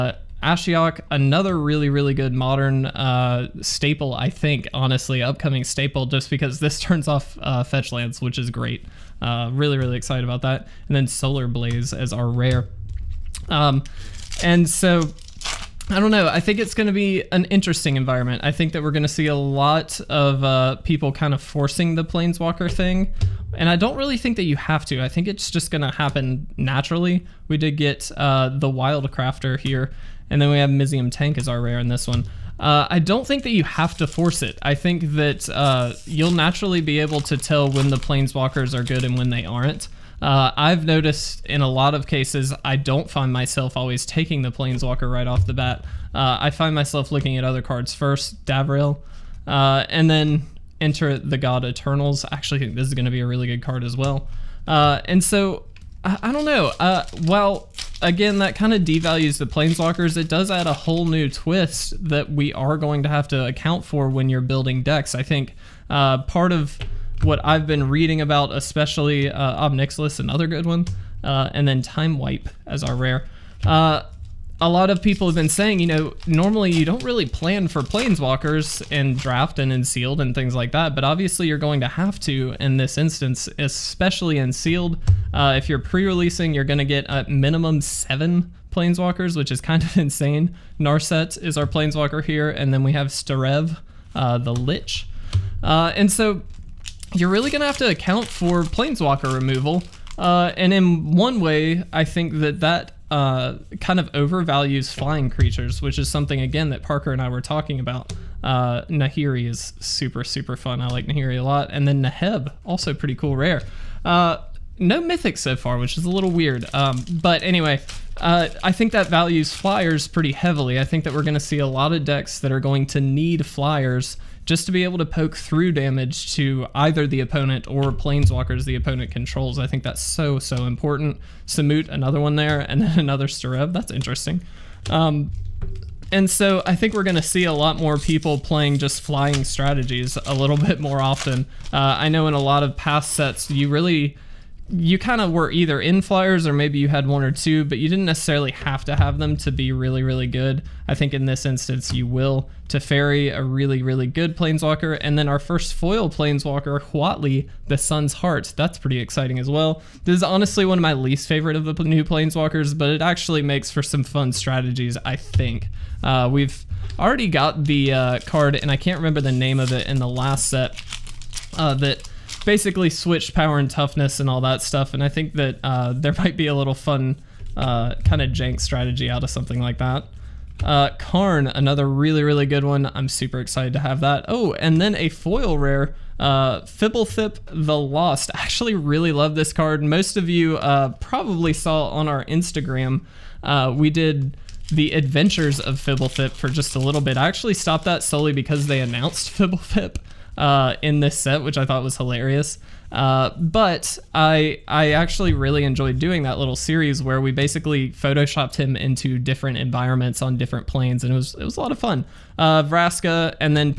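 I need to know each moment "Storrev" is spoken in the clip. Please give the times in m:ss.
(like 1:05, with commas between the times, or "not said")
1:33, 2:13.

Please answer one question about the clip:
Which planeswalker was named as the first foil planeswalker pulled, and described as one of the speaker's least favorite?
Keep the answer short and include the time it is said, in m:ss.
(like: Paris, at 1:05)
Huatli, the Sun's Heart, at 2:36.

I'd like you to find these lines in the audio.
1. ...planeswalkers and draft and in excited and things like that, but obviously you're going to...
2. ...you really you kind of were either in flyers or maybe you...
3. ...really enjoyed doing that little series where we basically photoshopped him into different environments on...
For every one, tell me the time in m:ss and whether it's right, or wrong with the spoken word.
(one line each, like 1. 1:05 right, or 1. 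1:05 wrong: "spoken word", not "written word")
1. 1:17 wrong: "sealed", not "excited"
2. 2:23 right
3. 3:25 right.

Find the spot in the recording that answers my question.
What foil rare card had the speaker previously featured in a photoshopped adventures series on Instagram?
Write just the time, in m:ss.
3:06.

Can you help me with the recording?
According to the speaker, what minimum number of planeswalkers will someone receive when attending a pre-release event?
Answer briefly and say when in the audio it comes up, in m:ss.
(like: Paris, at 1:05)
7, at 1:27.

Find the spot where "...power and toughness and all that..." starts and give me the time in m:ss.
2:53.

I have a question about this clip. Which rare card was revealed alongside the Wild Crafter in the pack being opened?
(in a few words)
Mizzium Tank.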